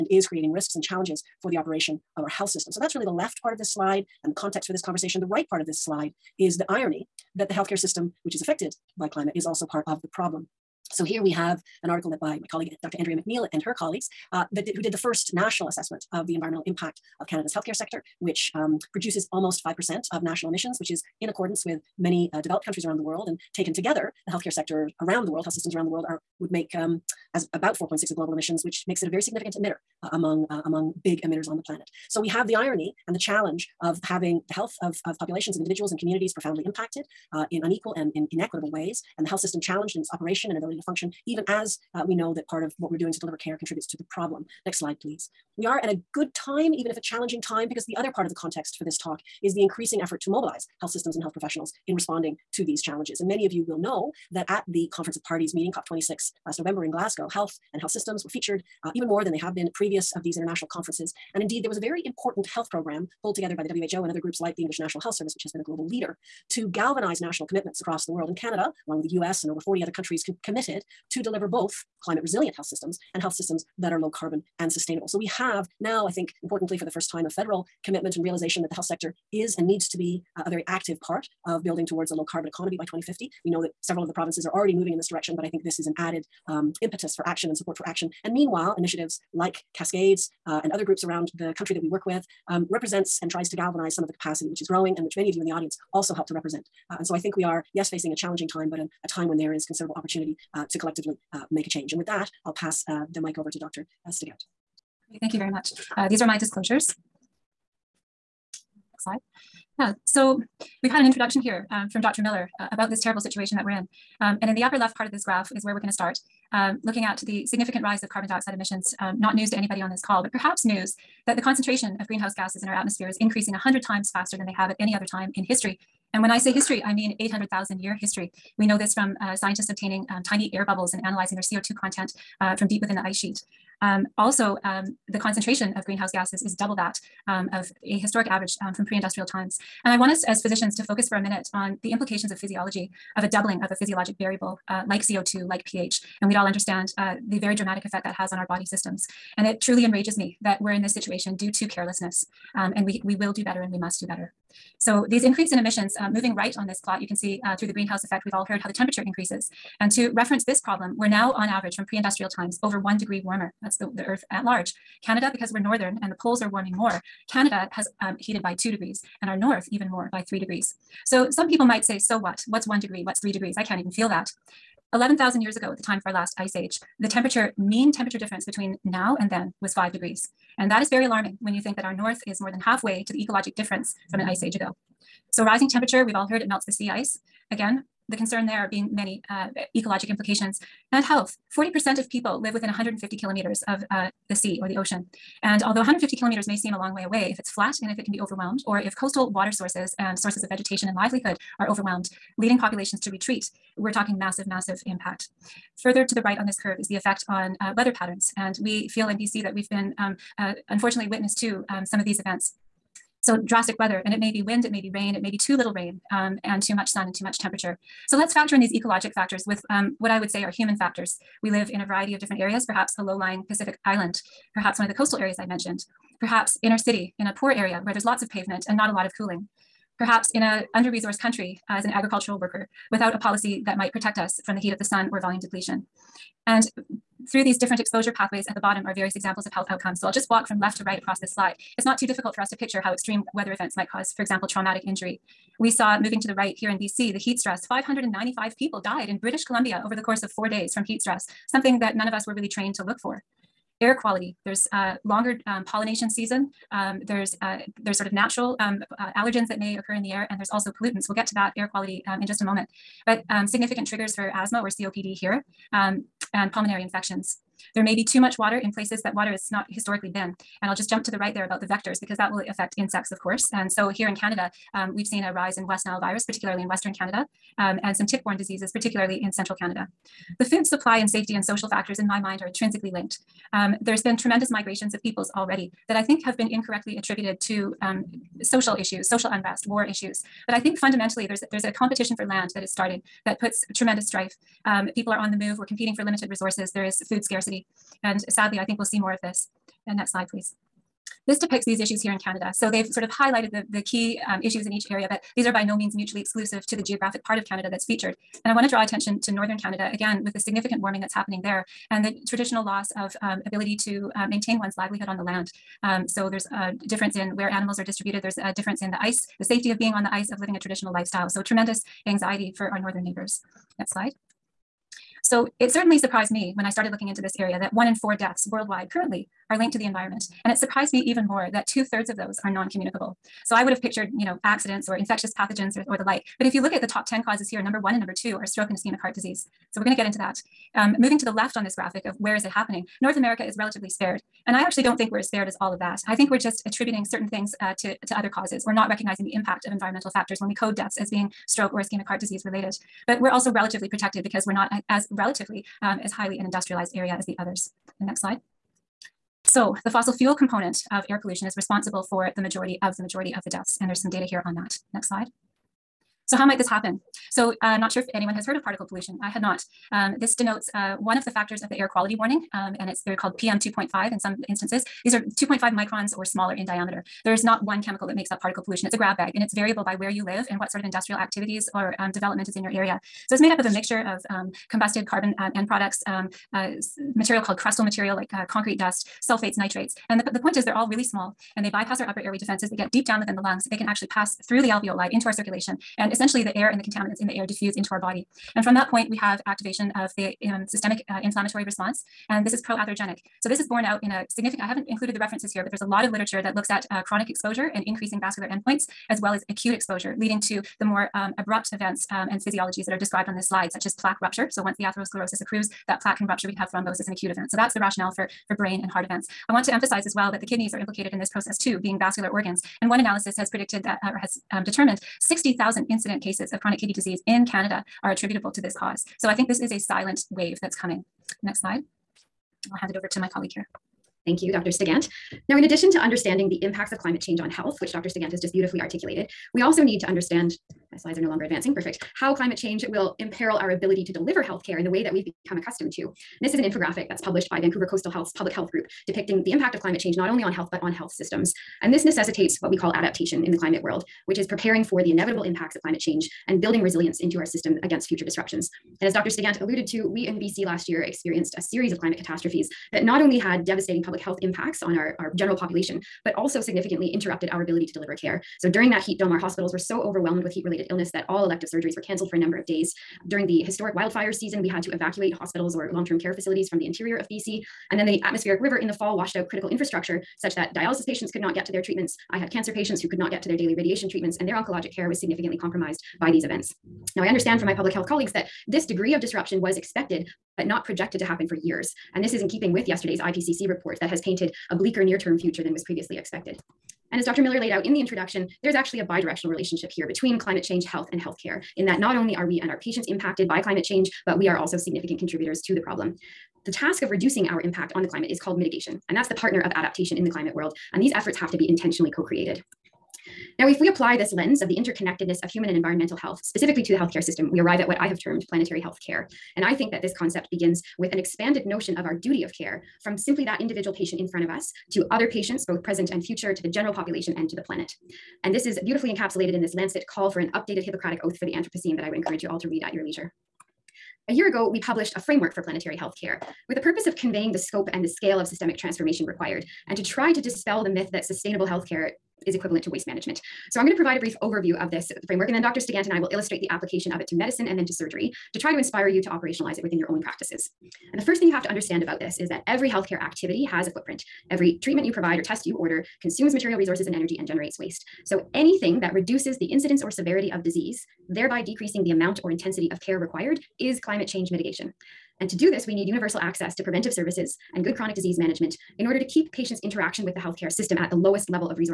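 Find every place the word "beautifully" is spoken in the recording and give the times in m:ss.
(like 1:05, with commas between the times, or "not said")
7:18, 8:48.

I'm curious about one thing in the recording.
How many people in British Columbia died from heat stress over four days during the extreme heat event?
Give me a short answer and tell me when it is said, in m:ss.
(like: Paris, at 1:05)
595, at 4:07.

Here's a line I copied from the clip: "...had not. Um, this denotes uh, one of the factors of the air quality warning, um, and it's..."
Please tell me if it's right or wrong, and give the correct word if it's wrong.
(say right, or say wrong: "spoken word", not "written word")
right.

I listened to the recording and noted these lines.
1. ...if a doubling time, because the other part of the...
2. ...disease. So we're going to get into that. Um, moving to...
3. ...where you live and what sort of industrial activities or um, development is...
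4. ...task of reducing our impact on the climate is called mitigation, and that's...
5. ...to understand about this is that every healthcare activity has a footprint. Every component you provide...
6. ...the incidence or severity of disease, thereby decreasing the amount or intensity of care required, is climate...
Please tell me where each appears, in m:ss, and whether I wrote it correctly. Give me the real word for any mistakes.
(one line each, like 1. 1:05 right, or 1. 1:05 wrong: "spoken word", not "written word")
1. 0:46 wrong: "challenging", not "doubling"
2. 5:39 right
3. 6:19 right
4. 8:26 right
5. 9:11 wrong: "treatment", not "component"
6. 9:19 right.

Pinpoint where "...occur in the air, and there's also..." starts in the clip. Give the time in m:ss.
4:19.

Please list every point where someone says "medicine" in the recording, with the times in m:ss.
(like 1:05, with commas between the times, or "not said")
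9:07.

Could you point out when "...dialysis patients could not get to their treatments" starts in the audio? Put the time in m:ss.
8:00.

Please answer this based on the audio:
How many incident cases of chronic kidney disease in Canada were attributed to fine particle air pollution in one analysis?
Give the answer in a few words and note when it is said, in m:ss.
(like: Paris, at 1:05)
60,000, at 7:05.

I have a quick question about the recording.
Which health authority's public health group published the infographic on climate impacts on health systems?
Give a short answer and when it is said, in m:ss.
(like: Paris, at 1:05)
Vancouver Coastal Health, at 7:27.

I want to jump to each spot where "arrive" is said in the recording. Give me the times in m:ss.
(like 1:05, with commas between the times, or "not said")
8:37.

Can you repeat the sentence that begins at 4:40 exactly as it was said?
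The food supply and safety and social factors, in my mind, are intrinsically linked.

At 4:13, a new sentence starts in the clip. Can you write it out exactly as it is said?
Air quality, there's a longer um, pollination season.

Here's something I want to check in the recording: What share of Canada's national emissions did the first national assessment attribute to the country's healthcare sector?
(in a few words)
almost 5%.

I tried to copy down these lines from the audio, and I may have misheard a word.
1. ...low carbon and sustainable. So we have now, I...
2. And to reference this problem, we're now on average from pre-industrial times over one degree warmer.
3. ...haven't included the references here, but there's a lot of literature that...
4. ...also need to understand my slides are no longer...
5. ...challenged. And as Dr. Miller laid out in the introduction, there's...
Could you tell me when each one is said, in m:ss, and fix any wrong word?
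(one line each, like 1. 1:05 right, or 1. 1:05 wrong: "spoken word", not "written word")
1. 1:13 right
2. 2:39 right
3. 6:44 right
4. 7:19 right
5. 8:16 wrong: "expected", not "challenged".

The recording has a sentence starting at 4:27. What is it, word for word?
There may be too much water in places that water has not historically been.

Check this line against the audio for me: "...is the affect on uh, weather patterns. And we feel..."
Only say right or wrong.
wrong.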